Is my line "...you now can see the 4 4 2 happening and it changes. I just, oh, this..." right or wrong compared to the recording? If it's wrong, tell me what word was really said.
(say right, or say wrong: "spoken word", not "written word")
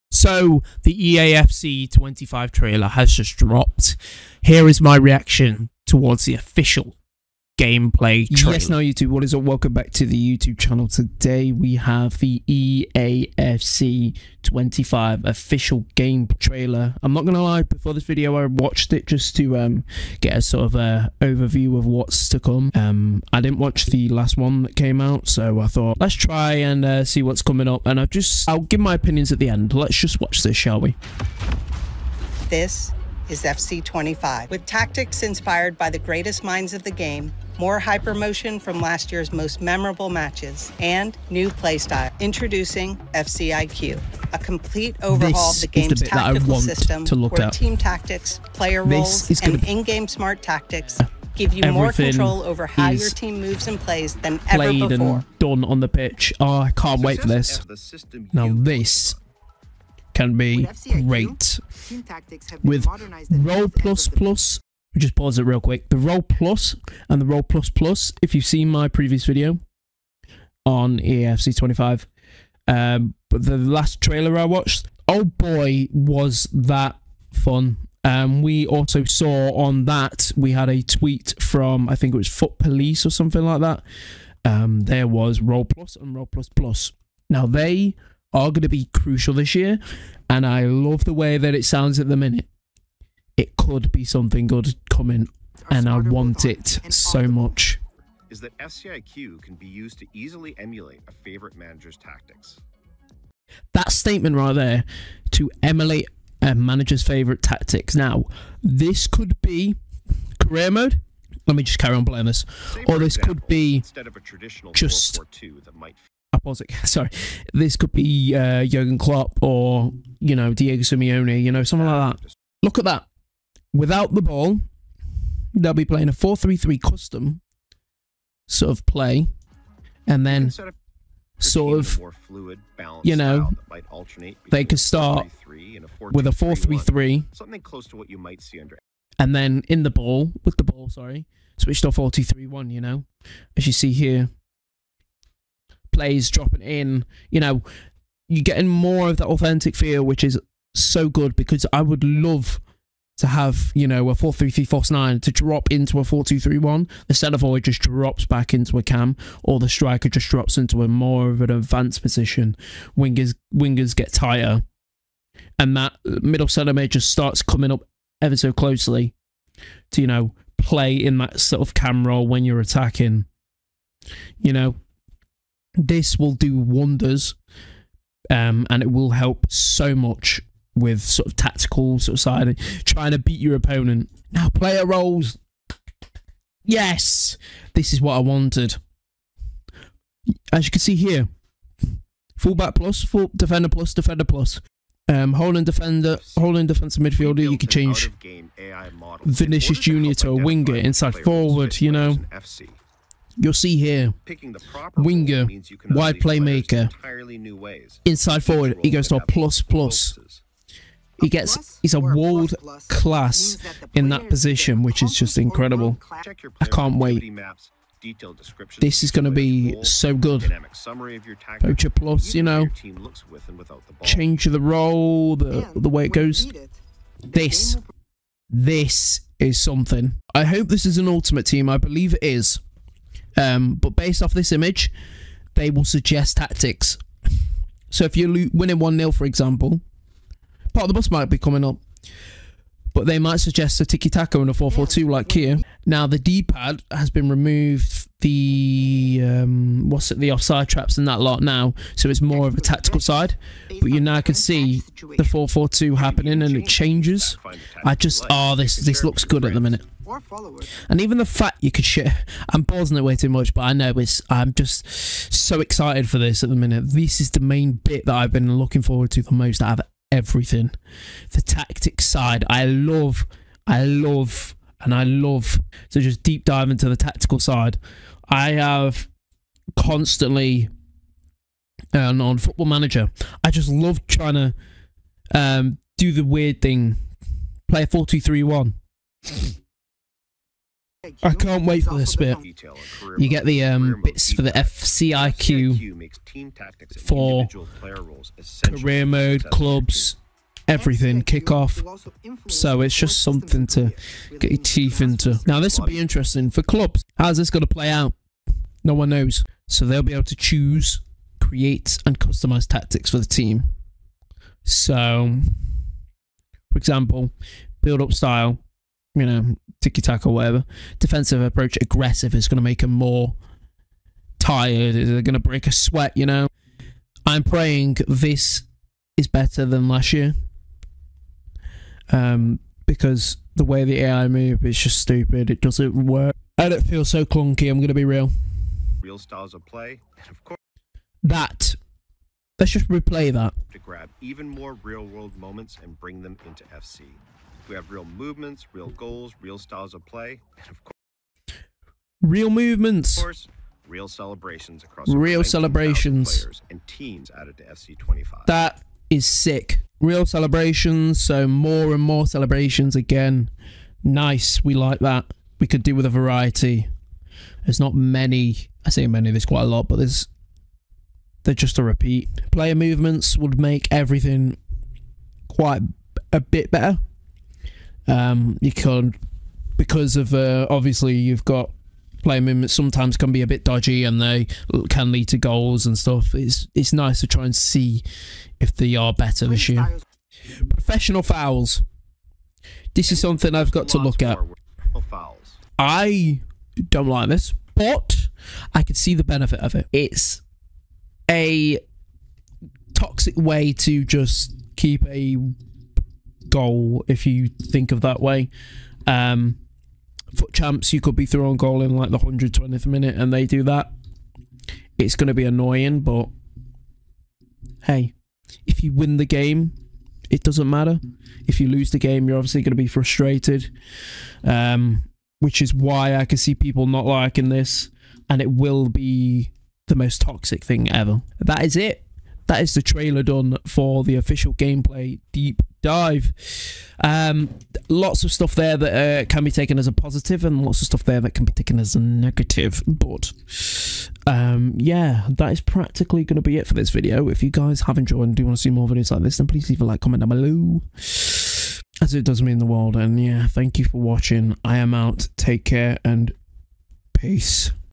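right.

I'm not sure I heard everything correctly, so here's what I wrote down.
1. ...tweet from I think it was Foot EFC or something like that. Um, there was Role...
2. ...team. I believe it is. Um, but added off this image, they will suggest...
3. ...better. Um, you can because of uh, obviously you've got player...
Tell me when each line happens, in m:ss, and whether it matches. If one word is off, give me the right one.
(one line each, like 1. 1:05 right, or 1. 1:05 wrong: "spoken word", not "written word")
1. 1:20 wrong: "Police", not "EFC"
2. 3:51 wrong: "based", not "added"
3. 6:16 right.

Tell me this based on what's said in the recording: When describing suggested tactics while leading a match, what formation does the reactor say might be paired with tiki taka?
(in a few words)
4 4 2.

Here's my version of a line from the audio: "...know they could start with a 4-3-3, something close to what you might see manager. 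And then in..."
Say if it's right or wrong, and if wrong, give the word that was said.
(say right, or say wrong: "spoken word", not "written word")
wrong: "under", not "manager".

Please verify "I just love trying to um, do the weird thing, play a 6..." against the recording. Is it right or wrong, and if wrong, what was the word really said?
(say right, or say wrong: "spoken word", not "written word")
wrong: "4", not "6".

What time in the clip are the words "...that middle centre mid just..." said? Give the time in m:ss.
2:45.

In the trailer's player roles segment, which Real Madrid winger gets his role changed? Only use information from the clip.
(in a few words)
Vinicius Junior.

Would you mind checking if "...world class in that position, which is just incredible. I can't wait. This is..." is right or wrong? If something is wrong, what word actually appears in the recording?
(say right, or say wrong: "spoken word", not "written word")
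right.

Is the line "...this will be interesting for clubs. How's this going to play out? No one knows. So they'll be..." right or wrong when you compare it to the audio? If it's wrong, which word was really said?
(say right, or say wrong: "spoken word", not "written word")
right.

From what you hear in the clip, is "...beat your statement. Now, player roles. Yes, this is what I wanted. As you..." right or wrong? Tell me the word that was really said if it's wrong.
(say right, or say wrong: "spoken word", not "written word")
wrong: "opponent", not "statement".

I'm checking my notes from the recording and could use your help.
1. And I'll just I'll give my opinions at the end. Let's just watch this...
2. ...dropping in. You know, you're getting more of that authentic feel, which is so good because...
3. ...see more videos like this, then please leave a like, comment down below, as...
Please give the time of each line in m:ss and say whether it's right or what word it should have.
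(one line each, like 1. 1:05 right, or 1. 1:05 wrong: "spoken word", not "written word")
1. 0:27 right
2. 2:26 right
3. 7:28 right.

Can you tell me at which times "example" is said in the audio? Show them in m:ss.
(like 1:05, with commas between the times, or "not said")
1:53, 3:59, 5:16.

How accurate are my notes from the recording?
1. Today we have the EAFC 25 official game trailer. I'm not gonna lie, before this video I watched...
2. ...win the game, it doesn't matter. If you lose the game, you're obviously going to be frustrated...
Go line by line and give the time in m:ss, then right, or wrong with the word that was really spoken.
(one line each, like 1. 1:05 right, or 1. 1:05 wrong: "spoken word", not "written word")
1. 0:10 right
2. 6:58 right.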